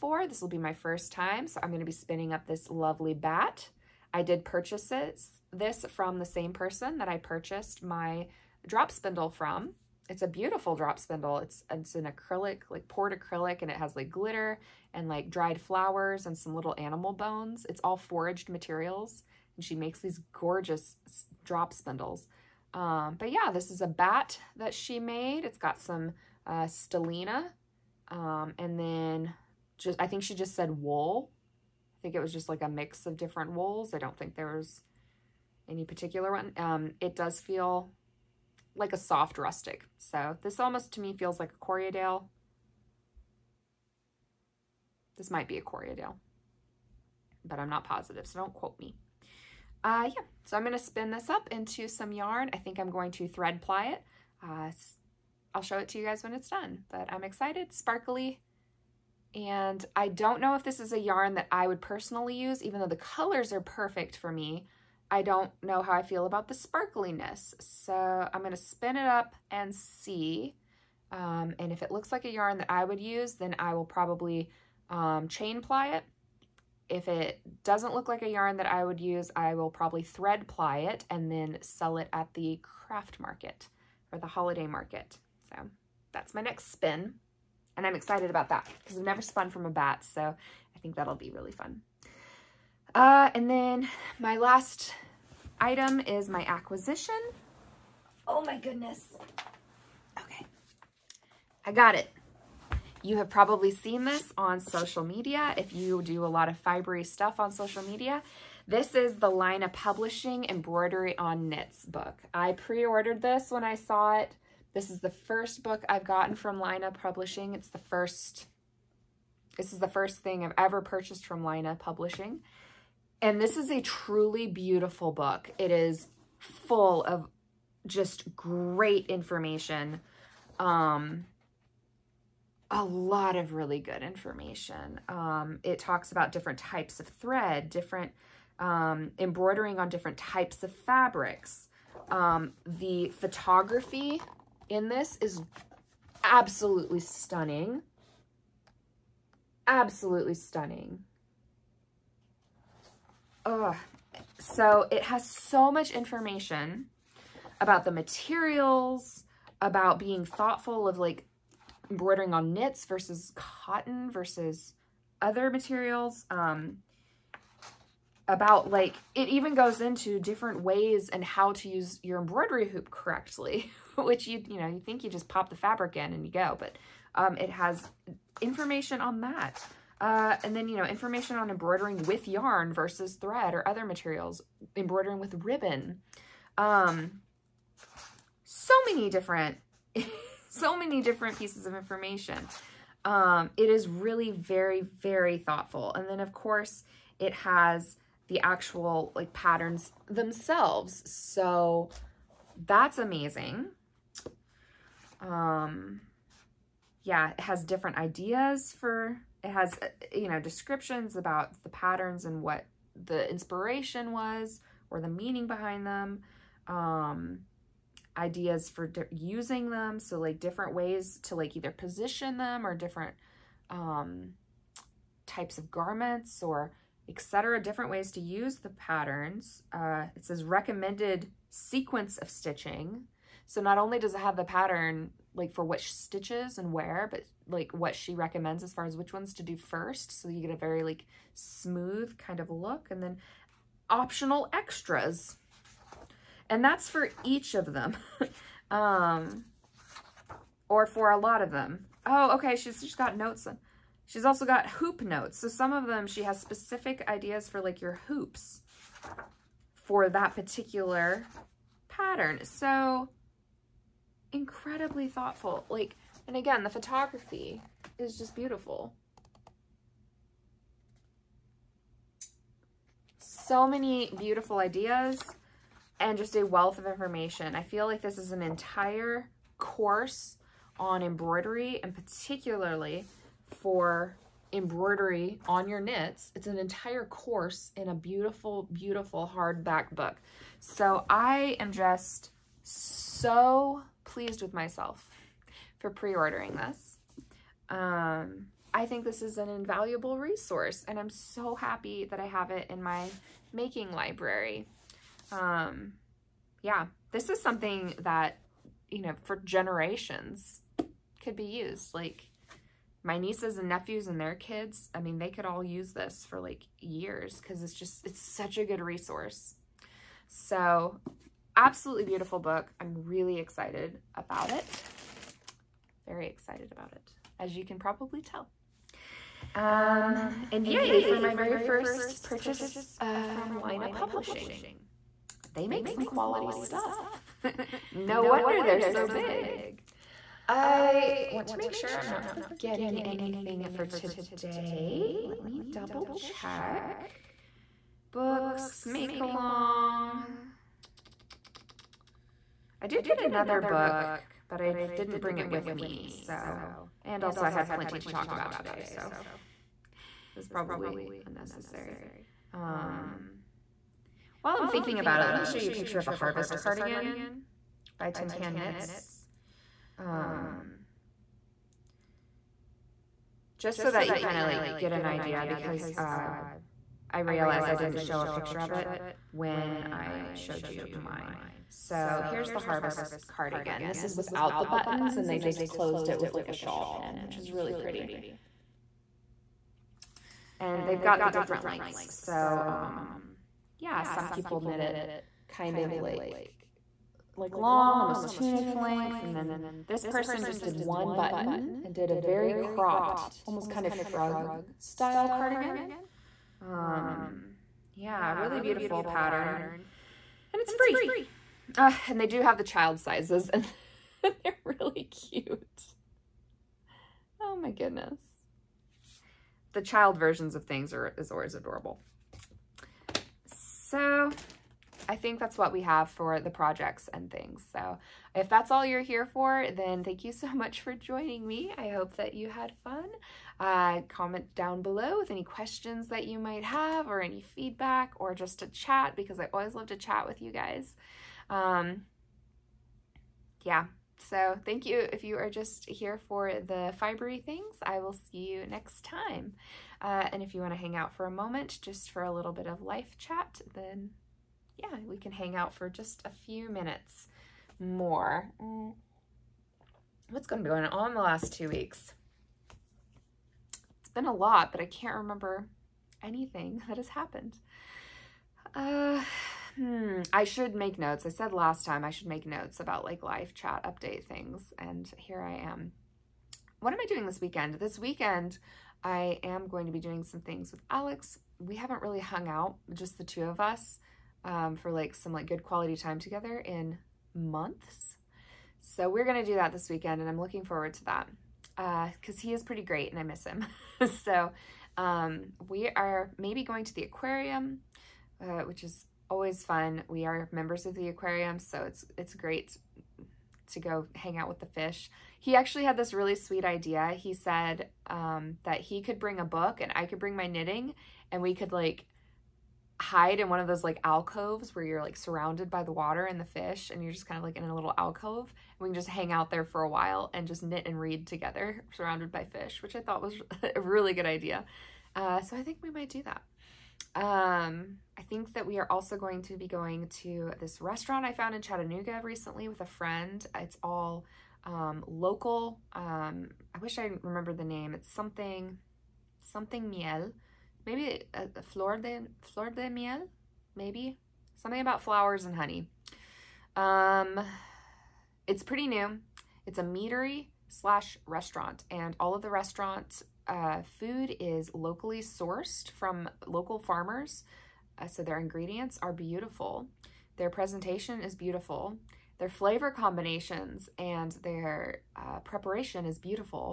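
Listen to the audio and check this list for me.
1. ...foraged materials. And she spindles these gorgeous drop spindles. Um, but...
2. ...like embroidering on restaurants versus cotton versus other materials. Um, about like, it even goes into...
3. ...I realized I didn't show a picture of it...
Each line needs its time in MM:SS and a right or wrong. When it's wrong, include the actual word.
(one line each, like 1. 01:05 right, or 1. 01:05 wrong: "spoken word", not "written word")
1. 00:17 wrong: "makes", not "spindles"
2. 02:40 wrong: "knits", not "restaurants"
3. 06:17 right.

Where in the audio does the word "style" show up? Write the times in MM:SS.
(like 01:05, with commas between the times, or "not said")
06:44.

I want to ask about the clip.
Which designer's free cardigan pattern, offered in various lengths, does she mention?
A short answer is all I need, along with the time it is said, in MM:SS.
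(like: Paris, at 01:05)
Tin Can Knits, at 06:08.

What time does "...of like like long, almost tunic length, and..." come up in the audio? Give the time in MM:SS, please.
06:35.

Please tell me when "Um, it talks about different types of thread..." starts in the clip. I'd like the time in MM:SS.
02:15.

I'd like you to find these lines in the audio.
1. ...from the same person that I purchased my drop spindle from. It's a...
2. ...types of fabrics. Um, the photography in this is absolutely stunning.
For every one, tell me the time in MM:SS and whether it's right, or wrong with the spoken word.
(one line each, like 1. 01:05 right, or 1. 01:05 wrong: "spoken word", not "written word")
1. 00:05 right
2. 02:20 right.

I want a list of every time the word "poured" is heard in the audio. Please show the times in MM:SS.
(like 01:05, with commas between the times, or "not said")
00:12.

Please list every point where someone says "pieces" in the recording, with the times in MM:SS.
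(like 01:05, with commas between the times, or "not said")
03:11.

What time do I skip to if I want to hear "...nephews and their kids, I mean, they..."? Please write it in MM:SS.
05:13.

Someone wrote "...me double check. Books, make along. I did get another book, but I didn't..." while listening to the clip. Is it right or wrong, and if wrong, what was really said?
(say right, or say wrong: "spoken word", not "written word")
right.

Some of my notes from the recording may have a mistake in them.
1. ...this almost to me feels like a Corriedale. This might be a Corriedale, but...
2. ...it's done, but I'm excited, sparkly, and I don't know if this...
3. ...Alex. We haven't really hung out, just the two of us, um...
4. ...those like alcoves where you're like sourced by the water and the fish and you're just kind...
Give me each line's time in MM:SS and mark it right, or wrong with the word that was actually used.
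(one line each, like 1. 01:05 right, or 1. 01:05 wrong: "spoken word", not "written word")
1. 00:40 right
2. 00:56 right
3. 08:00 right
4. 08:33 wrong: "surrounded", not "sourced".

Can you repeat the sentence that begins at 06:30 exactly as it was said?
And they've got the different lengths.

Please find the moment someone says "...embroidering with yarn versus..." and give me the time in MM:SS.
03:01.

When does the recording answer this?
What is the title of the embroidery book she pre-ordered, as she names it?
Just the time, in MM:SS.
01:50.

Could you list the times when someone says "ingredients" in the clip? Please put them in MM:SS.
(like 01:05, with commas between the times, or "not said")
09:18.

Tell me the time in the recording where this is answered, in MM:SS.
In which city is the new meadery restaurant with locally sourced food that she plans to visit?
08:51.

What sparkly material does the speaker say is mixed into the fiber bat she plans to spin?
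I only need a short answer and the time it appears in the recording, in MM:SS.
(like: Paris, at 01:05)
Stellina, at 00:26.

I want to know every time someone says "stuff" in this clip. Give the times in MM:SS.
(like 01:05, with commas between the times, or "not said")
01:47, 05:36.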